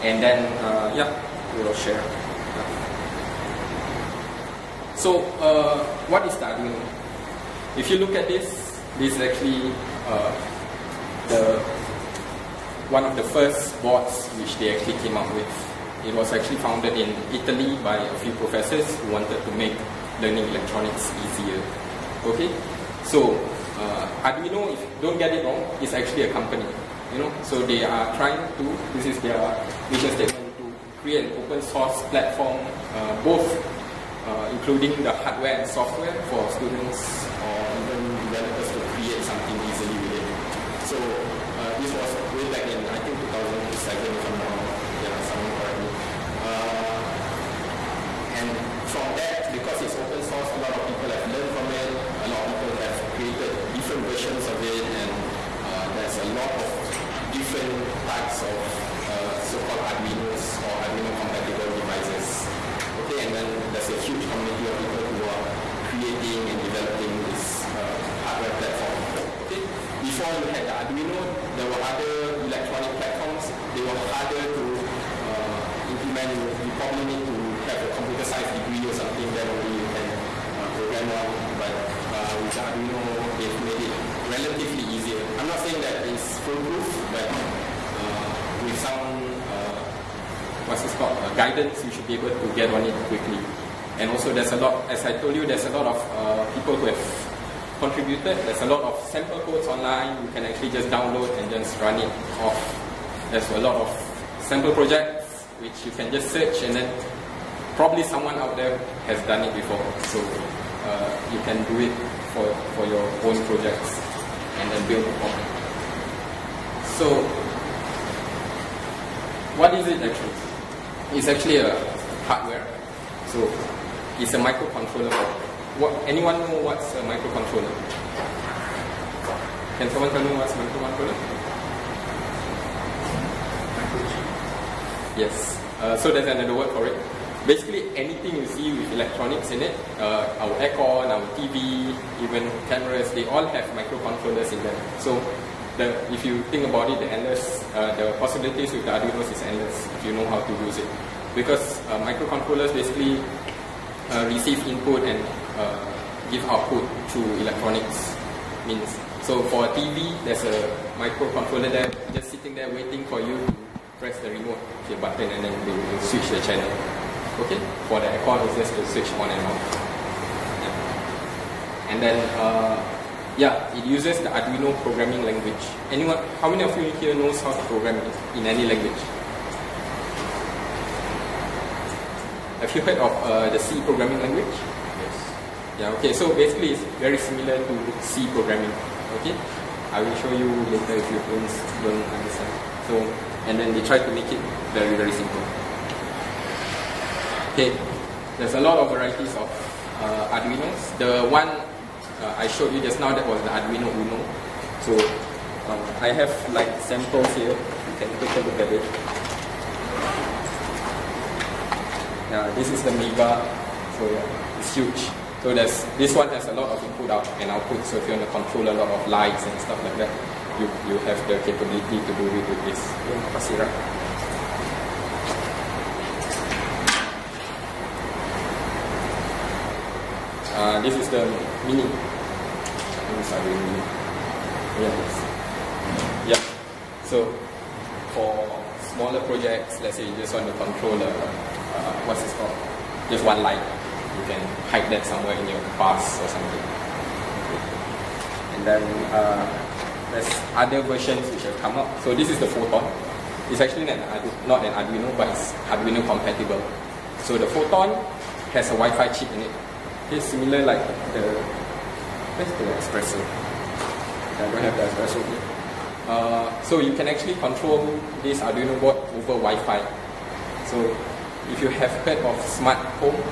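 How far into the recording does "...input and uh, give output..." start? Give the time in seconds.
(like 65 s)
154 s.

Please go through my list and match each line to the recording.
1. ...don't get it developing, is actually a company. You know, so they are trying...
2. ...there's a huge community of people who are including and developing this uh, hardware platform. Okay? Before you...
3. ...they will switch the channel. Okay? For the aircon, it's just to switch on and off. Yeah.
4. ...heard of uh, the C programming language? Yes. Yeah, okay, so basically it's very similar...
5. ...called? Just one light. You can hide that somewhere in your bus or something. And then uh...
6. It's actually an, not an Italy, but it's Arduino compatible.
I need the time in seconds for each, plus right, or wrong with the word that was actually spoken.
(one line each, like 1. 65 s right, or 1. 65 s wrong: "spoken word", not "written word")
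1. 25 s wrong: "wrong", not "developing"
2. 63 s wrong: "creating", not "including"
3. 165 s right
4. 182 s right
5. 242 s right
6. 253 s wrong: "Arduino", not "Italy".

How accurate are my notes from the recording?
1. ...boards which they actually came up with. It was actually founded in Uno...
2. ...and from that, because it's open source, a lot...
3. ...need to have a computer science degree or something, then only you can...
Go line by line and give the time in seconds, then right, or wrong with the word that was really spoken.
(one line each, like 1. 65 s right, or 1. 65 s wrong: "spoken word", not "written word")
1. 13 s wrong: "Italy", not "Uno"
2. 48 s right
3. 77 s right.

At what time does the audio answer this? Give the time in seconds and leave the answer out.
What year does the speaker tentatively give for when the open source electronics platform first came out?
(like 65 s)
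43 s.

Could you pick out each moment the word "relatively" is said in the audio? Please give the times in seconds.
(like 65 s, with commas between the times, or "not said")
84 s.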